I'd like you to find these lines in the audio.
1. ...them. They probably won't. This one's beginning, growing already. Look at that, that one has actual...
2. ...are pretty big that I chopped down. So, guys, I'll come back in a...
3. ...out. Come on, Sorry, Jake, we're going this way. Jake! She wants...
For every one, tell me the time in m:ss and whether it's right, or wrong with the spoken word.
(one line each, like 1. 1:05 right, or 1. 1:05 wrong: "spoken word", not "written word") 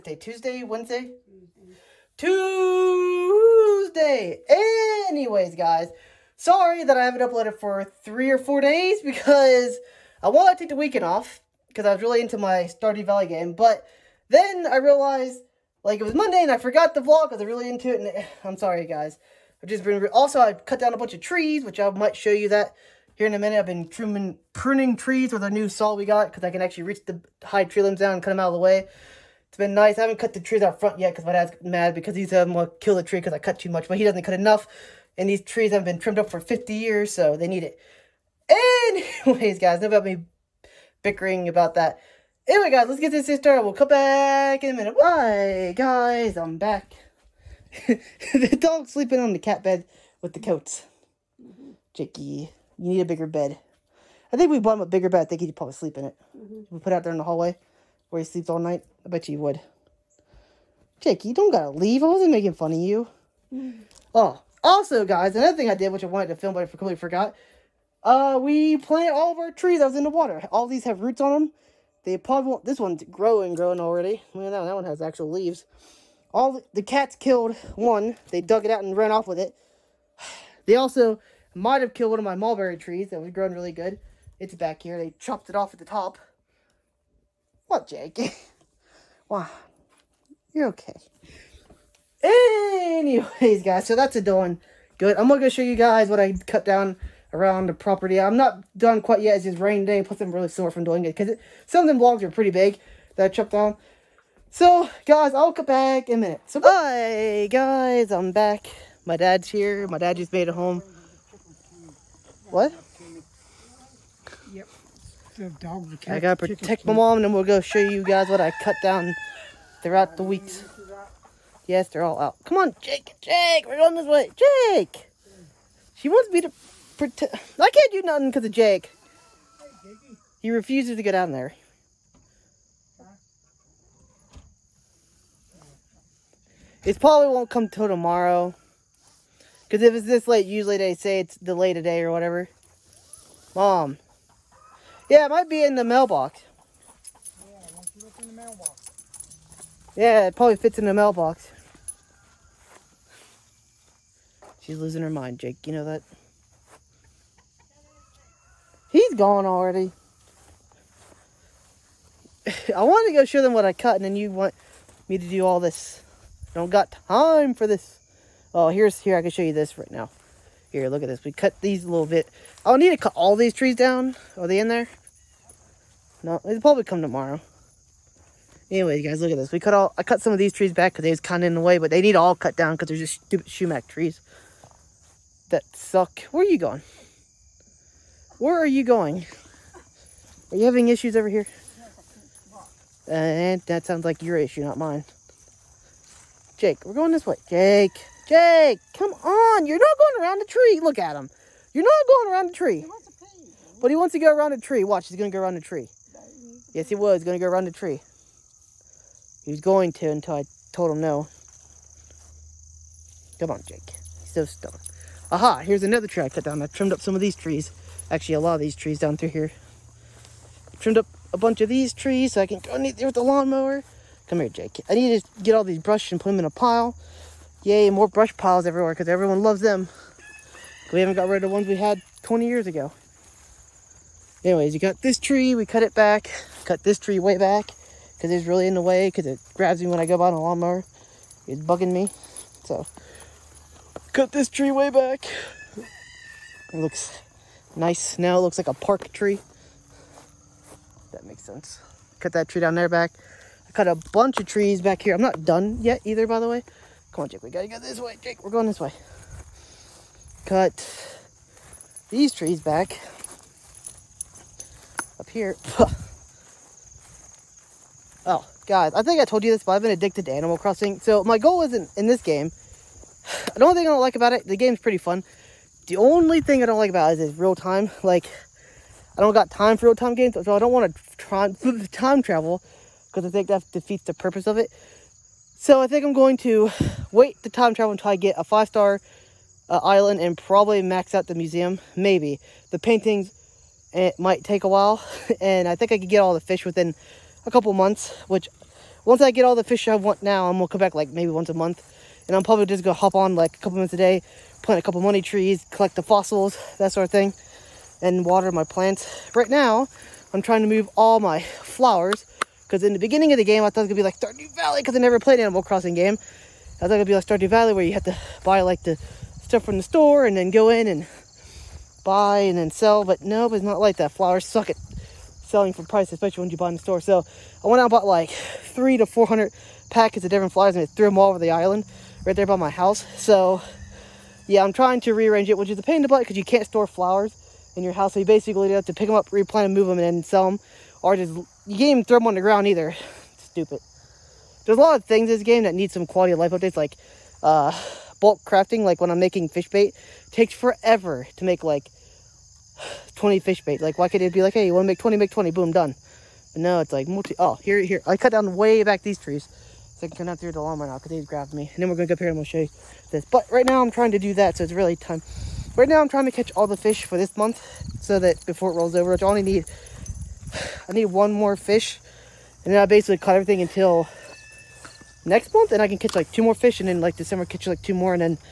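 1. 1:11 wrong: "growing", not "beginning"
2. 1:42 right
3. 2:02 wrong: "Jake", not "Sorry".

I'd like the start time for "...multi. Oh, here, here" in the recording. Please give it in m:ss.
5:57.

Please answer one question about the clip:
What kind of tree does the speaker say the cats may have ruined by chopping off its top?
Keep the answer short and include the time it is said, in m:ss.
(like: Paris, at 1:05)
Mulberry, at 1:22.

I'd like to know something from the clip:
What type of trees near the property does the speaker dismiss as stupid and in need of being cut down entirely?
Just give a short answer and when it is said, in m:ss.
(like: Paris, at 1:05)
Sumac, at 3:03.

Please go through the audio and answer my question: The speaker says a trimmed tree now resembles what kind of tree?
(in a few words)
A park tree.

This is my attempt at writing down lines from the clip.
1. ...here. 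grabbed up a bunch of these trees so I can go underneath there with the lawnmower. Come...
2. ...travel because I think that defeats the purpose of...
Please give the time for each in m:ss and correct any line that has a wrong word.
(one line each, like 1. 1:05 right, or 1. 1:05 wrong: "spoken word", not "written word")
1. 3:39 wrong: "trimmed", not "grabbed"
2. 4:42 right.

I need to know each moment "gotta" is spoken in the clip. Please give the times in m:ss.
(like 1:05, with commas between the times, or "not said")
1:01, 1:56, 4:17.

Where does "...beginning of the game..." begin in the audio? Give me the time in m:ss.
5:12.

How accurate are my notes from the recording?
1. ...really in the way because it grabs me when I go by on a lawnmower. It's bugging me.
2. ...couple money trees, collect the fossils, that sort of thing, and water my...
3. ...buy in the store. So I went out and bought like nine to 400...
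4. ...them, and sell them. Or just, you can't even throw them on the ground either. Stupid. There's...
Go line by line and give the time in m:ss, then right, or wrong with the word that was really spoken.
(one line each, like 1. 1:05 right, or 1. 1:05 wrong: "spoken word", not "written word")
1. 3:58 right
2. 5:04 right
3. 5:26 wrong: "three", not "nine"
4. 5:39 right.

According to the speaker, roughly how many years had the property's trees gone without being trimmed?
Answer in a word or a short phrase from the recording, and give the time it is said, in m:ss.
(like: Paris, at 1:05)
50, at 0:36.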